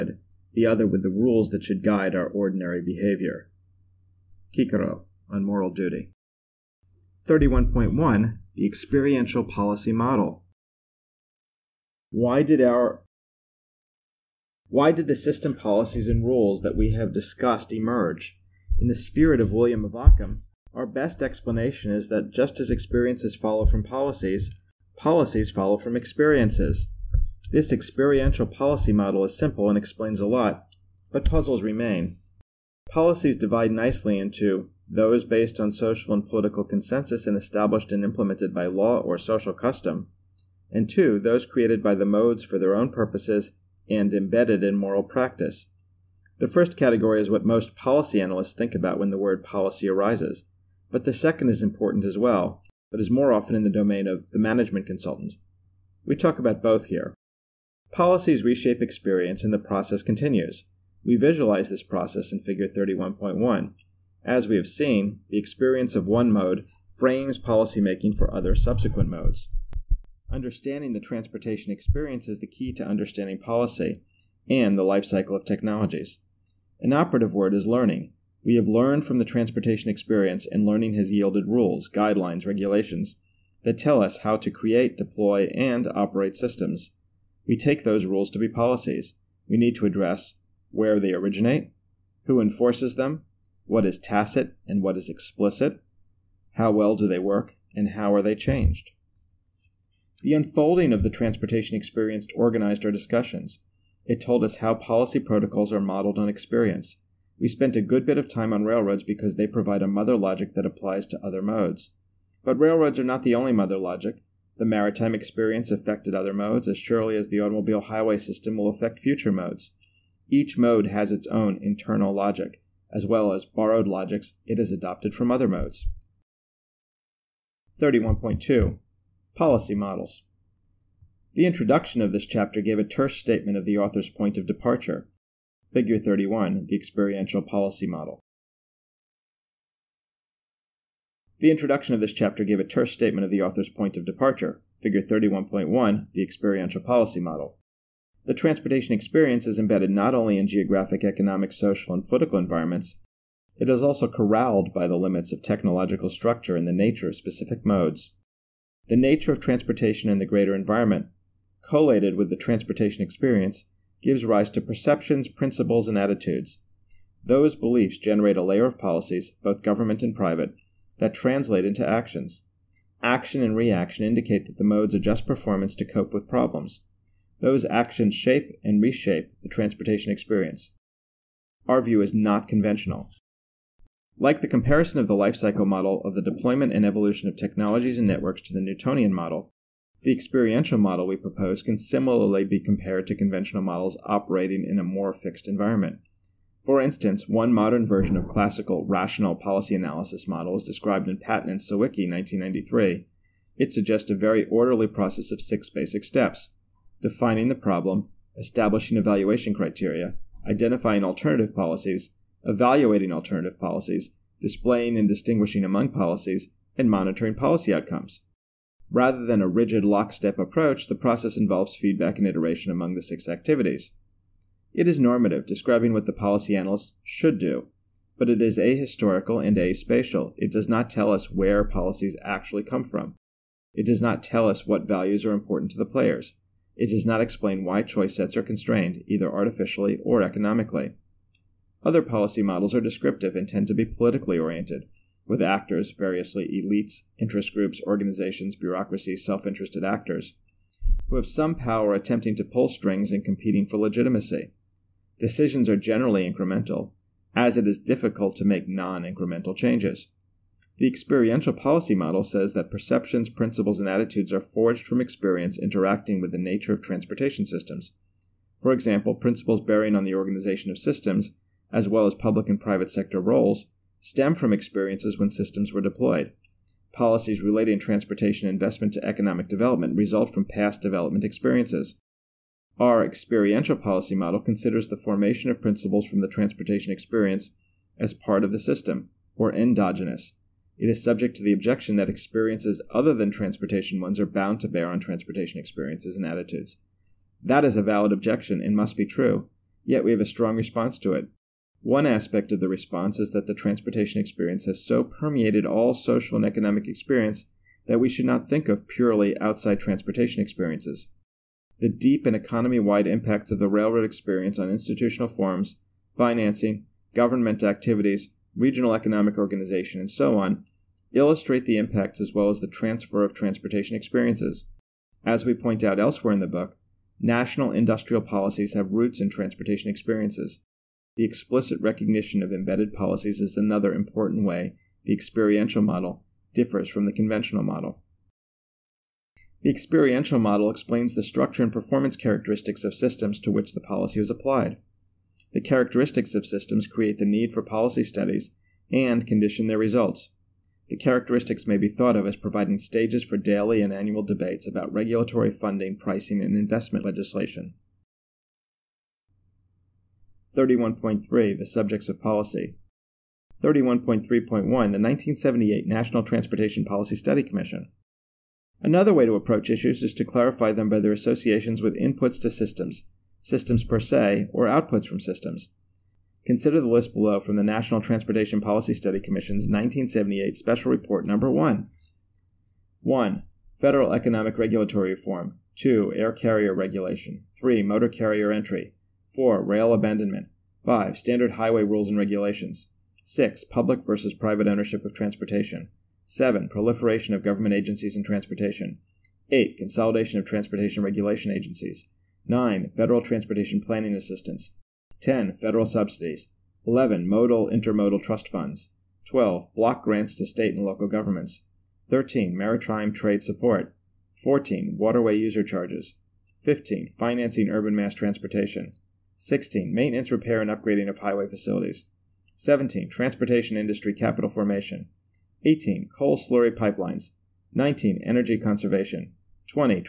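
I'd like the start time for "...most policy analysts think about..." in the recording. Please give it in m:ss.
0:47.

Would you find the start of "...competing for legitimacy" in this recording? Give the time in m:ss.
4:13.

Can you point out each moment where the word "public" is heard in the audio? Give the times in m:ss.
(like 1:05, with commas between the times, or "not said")
4:32, 6:33.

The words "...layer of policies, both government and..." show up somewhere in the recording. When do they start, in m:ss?
2:48.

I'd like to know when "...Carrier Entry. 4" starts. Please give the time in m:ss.
6:28.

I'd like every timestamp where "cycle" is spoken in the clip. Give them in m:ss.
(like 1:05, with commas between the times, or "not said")
1:15, 3:05.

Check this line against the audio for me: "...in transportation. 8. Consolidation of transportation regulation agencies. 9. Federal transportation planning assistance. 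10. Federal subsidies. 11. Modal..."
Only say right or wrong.
right.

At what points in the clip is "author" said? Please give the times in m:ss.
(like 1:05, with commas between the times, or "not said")
2:13, 2:23.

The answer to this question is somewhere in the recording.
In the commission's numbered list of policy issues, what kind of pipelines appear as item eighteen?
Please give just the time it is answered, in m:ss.
7:06.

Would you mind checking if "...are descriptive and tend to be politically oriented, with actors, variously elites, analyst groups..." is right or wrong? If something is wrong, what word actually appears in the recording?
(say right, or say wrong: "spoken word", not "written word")
wrong: "interest", not "analyst".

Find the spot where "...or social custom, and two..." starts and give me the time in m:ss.
0:39.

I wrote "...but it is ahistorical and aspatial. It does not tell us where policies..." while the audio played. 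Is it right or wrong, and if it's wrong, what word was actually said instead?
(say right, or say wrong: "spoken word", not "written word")
right.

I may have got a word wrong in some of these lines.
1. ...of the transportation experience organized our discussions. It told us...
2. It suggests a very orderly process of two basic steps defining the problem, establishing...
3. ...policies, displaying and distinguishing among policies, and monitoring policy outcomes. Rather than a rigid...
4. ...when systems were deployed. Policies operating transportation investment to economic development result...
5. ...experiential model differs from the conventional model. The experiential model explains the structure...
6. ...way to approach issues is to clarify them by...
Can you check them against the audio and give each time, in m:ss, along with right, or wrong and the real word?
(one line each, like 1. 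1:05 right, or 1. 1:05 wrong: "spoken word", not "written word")
1. 1:40 right
2. 3:23 wrong: "six", not "two"
3. 3:33 right
4. 4:35 wrong: "relating", not "operating"
5. 5:35 right
6. 6:09 right.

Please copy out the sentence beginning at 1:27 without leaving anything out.
We take those rules to be policies.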